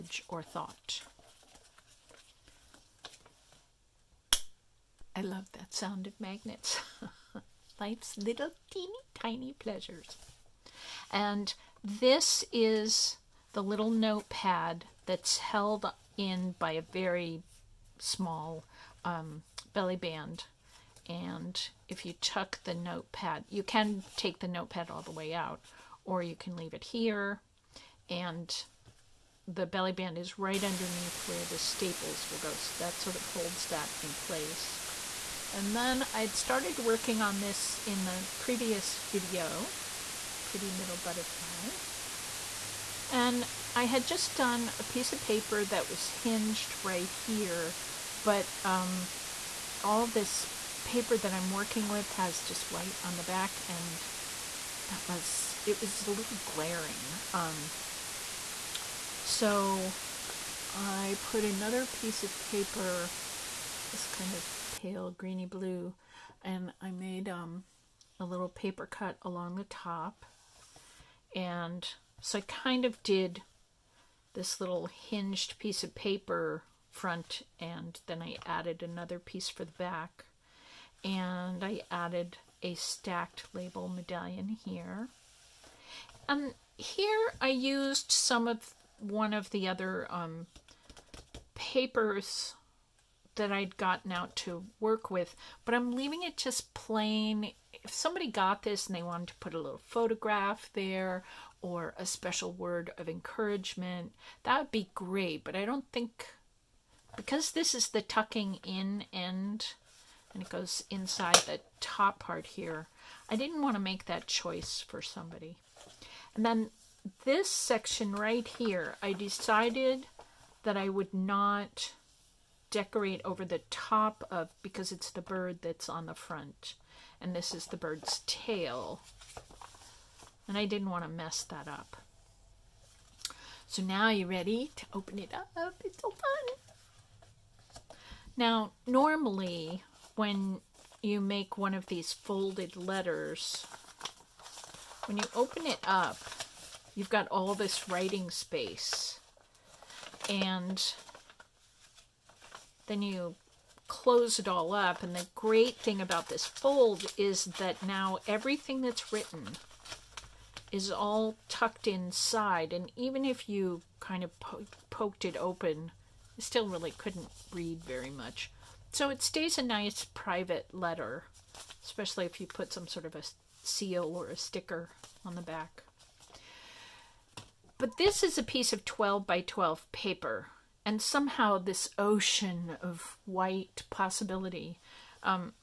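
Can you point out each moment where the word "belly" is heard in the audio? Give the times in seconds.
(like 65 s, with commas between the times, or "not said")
19 s, 29 s.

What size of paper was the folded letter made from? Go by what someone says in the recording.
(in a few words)
12 by 12.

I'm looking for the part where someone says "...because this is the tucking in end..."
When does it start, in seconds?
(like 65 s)
107 s.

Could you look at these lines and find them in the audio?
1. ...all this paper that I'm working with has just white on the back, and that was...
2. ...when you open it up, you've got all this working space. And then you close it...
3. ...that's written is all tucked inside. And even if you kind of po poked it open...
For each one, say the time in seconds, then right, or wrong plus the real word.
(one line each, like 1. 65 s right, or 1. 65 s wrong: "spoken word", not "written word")
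1. 49 s right
2. 145 s wrong: "writing", not "working"
3. 158 s right.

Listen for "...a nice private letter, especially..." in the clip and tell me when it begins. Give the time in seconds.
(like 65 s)
169 s.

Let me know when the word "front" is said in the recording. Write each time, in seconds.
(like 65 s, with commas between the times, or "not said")
76 s, 126 s.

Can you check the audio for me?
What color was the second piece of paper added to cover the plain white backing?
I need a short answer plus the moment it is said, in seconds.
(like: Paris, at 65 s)
pale greeny blue, at 64 s.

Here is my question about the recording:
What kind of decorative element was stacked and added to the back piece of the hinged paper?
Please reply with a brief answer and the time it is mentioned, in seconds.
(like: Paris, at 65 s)
label medallion, at 83 s.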